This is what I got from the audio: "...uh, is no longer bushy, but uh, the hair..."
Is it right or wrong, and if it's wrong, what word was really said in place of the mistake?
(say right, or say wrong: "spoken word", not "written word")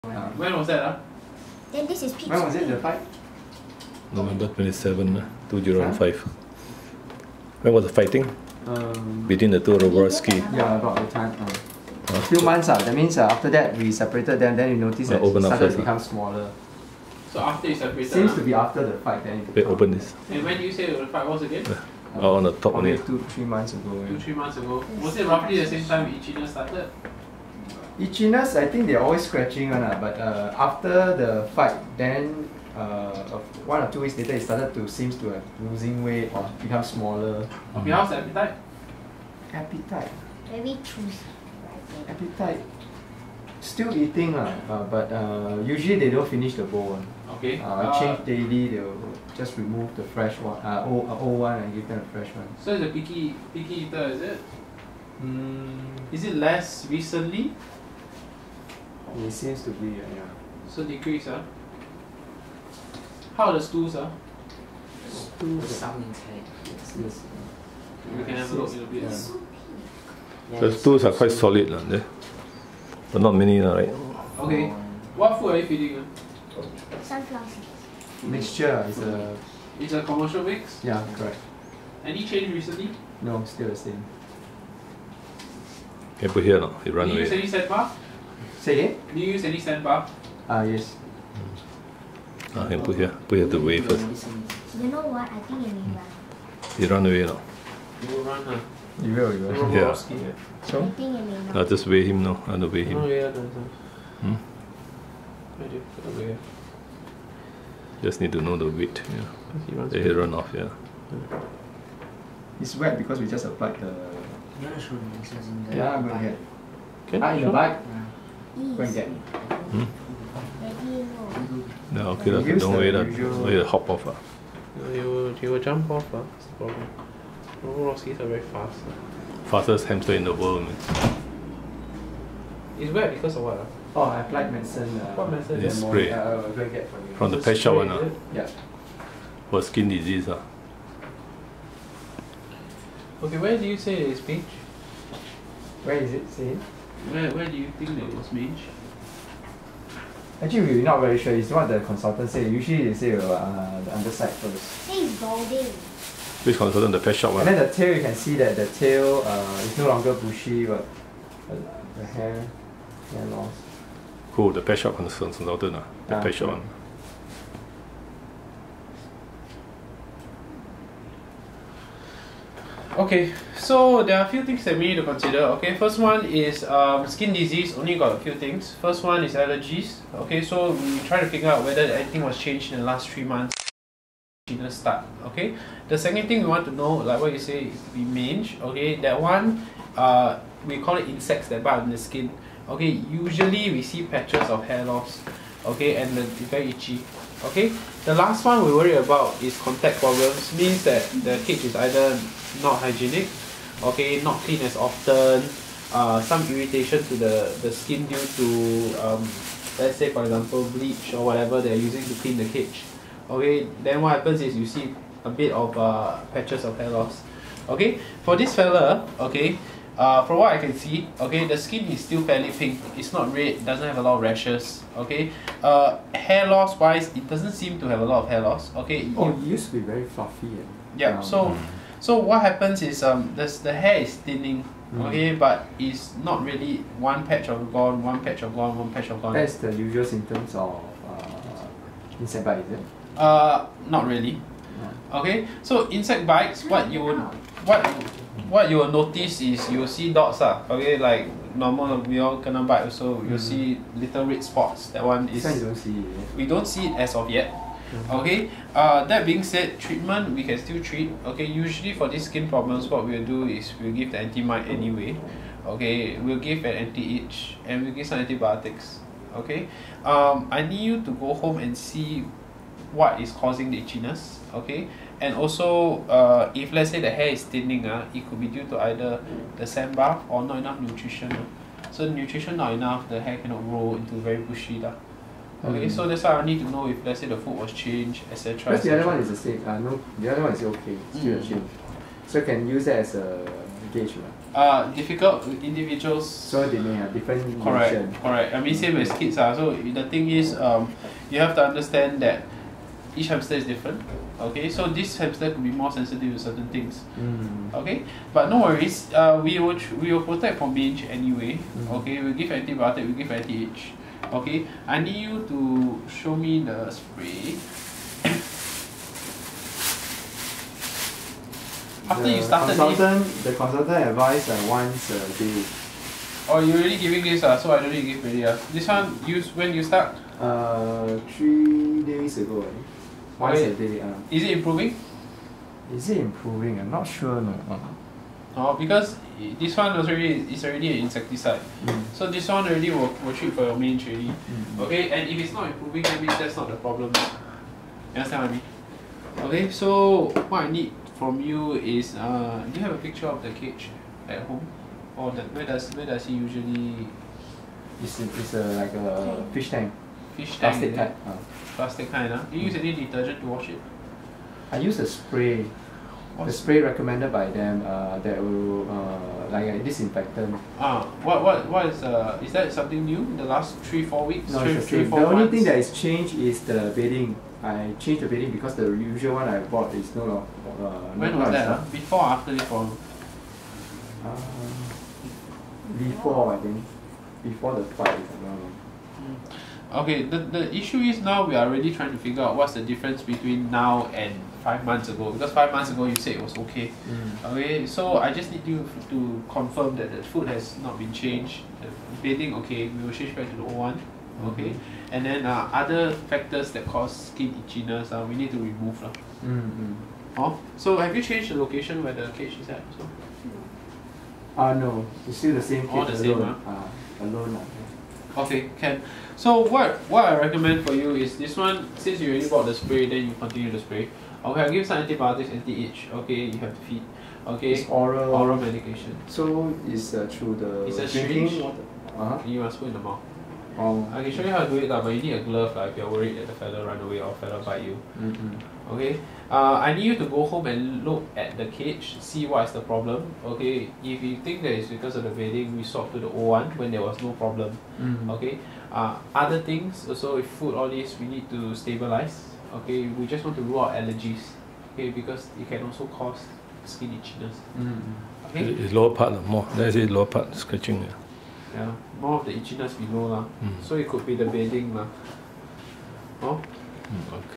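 right.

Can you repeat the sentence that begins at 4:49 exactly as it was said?
Uh, no, the other one is okay, still mm.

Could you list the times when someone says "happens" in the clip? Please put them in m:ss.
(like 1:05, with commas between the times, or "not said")
3:34, 3:52.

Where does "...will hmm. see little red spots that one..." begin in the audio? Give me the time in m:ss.
4:13.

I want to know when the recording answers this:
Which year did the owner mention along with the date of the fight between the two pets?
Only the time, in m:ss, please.
0:05.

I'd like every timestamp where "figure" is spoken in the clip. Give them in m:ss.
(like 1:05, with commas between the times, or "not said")
3:01, 6:32.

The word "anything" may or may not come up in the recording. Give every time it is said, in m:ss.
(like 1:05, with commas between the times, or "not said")
3:01.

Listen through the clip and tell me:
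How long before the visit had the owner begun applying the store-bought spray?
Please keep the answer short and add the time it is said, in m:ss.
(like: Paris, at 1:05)
3 days ago, at 5:31.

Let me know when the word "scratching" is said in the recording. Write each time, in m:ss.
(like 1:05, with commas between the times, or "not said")
0:29, 7:40.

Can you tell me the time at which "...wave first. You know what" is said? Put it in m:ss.
1:33.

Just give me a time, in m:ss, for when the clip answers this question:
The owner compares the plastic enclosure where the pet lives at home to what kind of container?
5:59.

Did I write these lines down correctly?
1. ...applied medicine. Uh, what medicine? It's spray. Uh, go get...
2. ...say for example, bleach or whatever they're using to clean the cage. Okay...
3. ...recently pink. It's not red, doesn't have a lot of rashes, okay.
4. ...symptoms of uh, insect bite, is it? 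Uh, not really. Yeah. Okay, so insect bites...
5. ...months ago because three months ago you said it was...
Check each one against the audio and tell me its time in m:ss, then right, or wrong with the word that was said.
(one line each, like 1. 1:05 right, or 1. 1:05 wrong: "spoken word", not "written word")
1. 2:14 right
2. 3:29 right
3. 3:42 wrong: "fairly", not "recently"
4. 4:00 right
5. 6:34 wrong: "five", not "three".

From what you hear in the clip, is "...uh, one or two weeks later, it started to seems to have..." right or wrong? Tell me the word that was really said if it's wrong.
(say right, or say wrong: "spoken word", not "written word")
right.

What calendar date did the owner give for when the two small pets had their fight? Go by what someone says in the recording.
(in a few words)
November 27.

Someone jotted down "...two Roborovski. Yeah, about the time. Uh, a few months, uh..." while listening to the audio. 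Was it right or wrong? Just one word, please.
right.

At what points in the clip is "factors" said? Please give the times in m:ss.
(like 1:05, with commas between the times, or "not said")
6:46.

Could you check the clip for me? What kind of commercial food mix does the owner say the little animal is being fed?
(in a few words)
Sunflower mixture.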